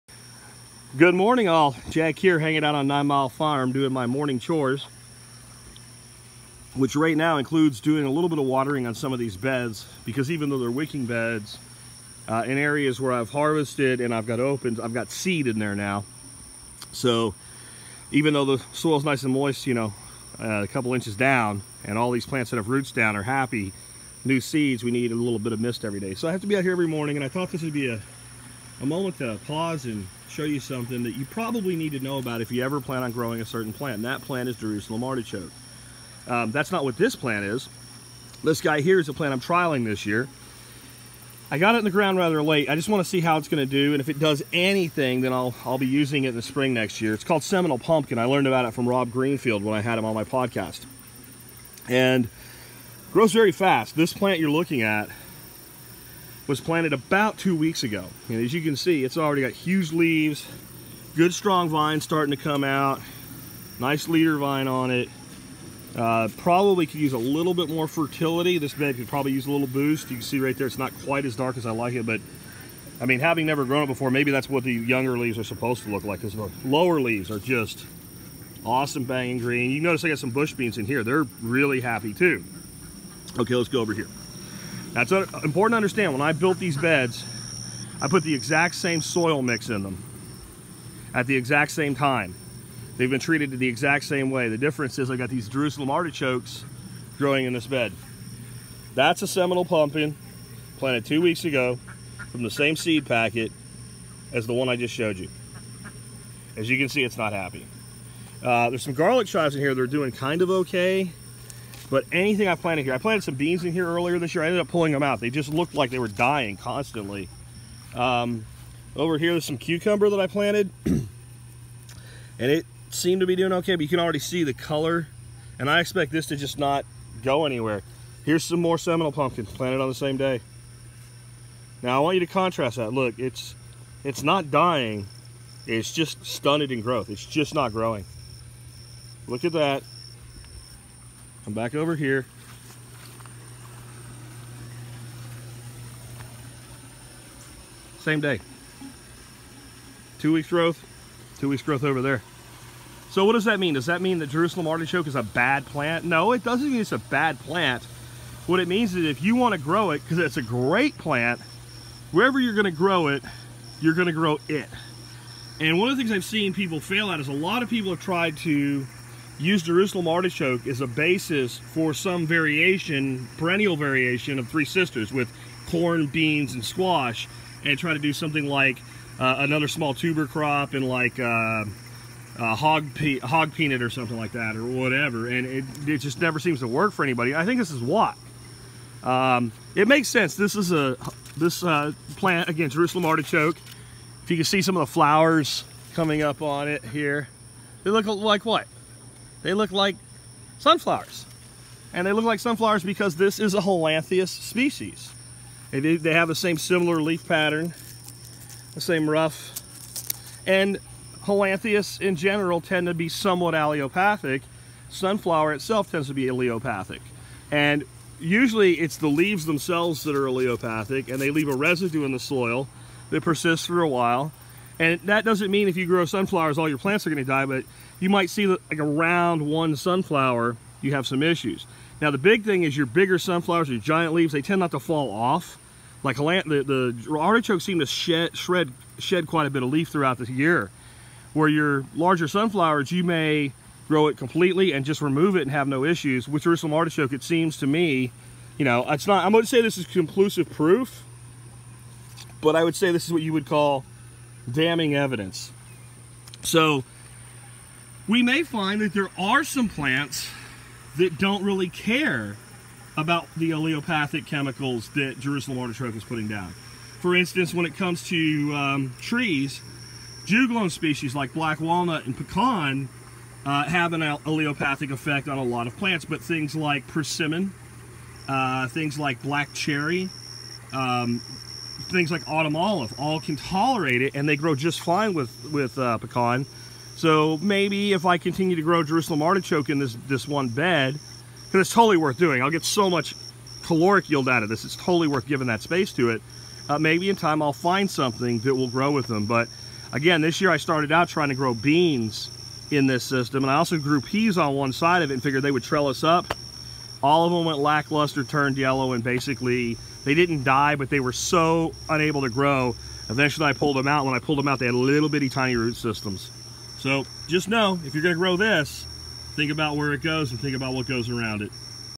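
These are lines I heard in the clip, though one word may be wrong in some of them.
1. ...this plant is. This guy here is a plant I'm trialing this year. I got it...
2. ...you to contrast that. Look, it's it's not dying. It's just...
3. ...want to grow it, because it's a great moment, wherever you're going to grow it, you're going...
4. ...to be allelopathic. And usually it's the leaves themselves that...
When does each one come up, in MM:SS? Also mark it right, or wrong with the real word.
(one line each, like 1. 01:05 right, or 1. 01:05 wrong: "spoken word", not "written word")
1. 00:36 right
2. 02:12 right
3. 02:39 wrong: "plant", not "moment"
4. 03:36 right.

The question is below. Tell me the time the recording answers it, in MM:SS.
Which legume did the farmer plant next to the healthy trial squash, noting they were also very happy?
01:20.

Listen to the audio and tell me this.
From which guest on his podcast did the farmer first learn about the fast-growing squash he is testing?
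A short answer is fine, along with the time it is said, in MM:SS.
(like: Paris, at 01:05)
Rob Greenfield, at 00:48.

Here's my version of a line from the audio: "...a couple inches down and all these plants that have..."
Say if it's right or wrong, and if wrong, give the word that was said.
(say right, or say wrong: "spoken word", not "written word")
right.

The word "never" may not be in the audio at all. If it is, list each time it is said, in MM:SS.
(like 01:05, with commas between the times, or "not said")
01:13, 03:06.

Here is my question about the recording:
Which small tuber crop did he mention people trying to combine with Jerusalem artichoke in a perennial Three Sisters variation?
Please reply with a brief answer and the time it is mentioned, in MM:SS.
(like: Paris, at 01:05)
hog peanut, at 03:03.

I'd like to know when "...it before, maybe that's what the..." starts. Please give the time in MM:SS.
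01:13.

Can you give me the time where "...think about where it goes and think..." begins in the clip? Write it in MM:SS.
05:19.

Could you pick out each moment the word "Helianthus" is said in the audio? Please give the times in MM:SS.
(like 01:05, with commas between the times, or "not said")
03:23, 03:31.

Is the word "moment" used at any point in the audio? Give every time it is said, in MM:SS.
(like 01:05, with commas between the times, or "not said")
00:28.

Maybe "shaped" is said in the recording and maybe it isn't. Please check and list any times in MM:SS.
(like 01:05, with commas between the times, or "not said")
not said.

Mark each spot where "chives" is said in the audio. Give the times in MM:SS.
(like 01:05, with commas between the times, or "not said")
01:49.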